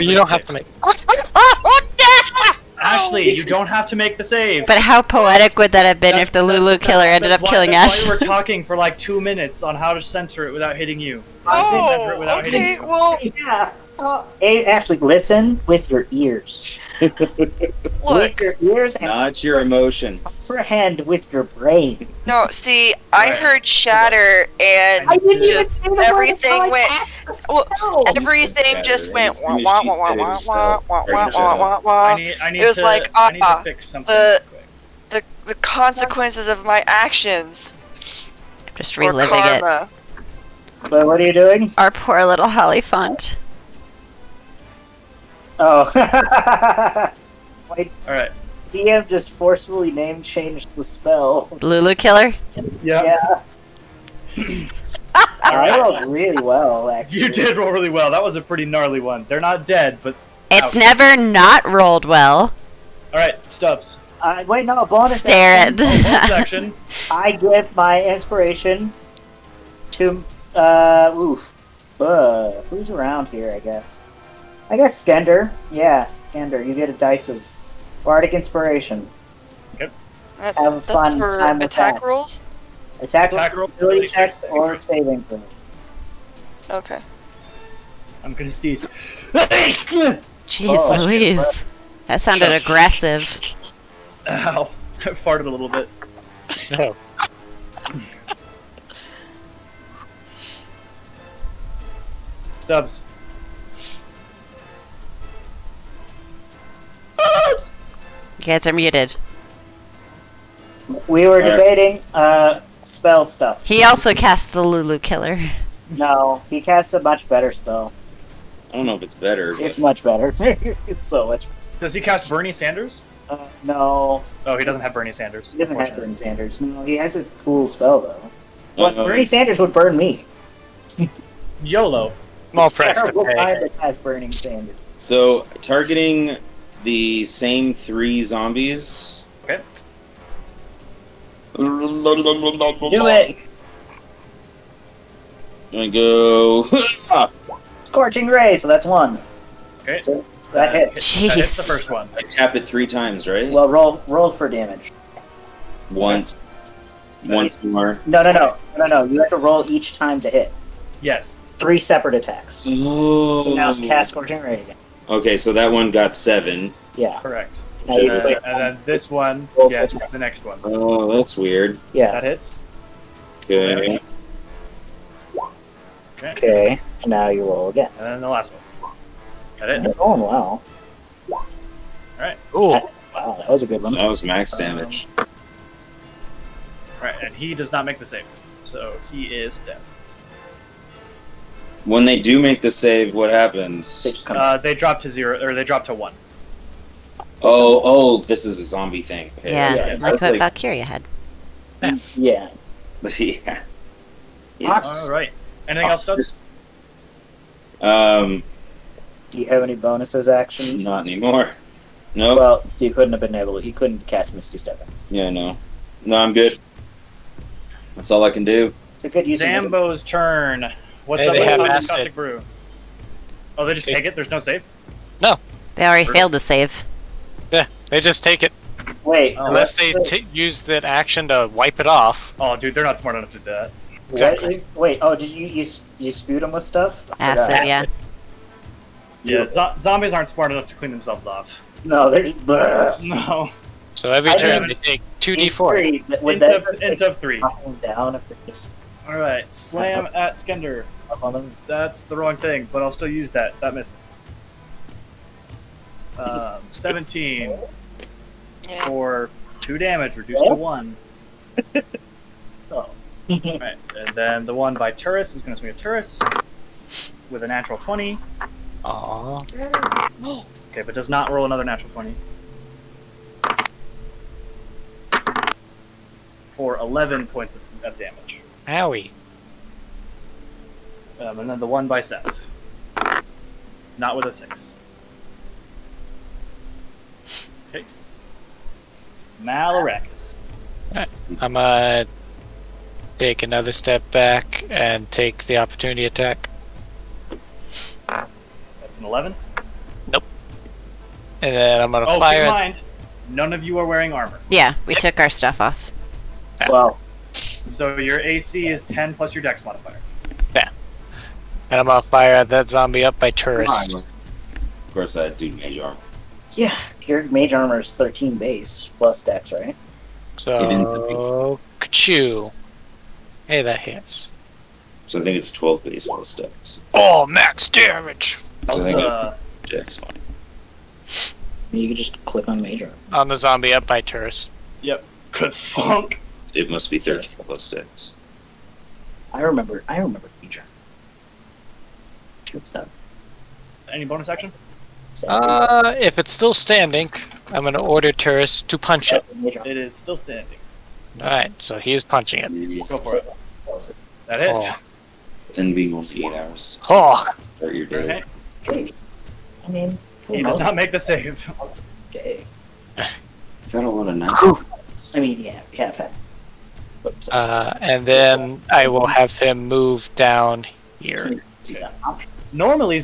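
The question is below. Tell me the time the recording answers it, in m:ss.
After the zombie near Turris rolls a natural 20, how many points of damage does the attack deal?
4:36.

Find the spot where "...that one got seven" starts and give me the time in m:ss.
2:45.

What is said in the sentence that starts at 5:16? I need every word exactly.
Yeah, your mage armor is 13 base plus dex, right?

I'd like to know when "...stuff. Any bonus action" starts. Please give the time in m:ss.
5:42.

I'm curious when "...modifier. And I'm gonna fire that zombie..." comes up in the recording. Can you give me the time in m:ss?
5:09.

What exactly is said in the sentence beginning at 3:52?
Oh, dude, they're not smart enough to do that.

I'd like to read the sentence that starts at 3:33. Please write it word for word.
To, he couldn't cast Misty Step.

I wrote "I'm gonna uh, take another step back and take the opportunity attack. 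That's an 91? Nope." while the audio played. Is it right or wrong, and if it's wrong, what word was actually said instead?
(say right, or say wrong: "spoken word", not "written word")
wrong: "11", not "91".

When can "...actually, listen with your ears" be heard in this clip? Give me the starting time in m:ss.
0:14.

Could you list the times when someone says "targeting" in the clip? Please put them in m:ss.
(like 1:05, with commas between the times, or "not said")
2:15.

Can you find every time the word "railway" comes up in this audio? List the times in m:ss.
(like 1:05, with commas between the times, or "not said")
not said.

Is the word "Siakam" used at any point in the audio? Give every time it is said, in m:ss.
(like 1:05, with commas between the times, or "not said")
not said.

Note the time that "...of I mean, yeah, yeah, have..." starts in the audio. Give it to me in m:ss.
6:04.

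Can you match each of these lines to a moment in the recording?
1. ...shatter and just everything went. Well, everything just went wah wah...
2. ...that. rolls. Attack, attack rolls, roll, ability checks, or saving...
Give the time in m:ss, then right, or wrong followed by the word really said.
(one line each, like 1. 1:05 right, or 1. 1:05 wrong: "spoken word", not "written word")
1. 0:23 right
2. 1:21 right.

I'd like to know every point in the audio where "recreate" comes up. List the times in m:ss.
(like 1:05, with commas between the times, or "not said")
not said.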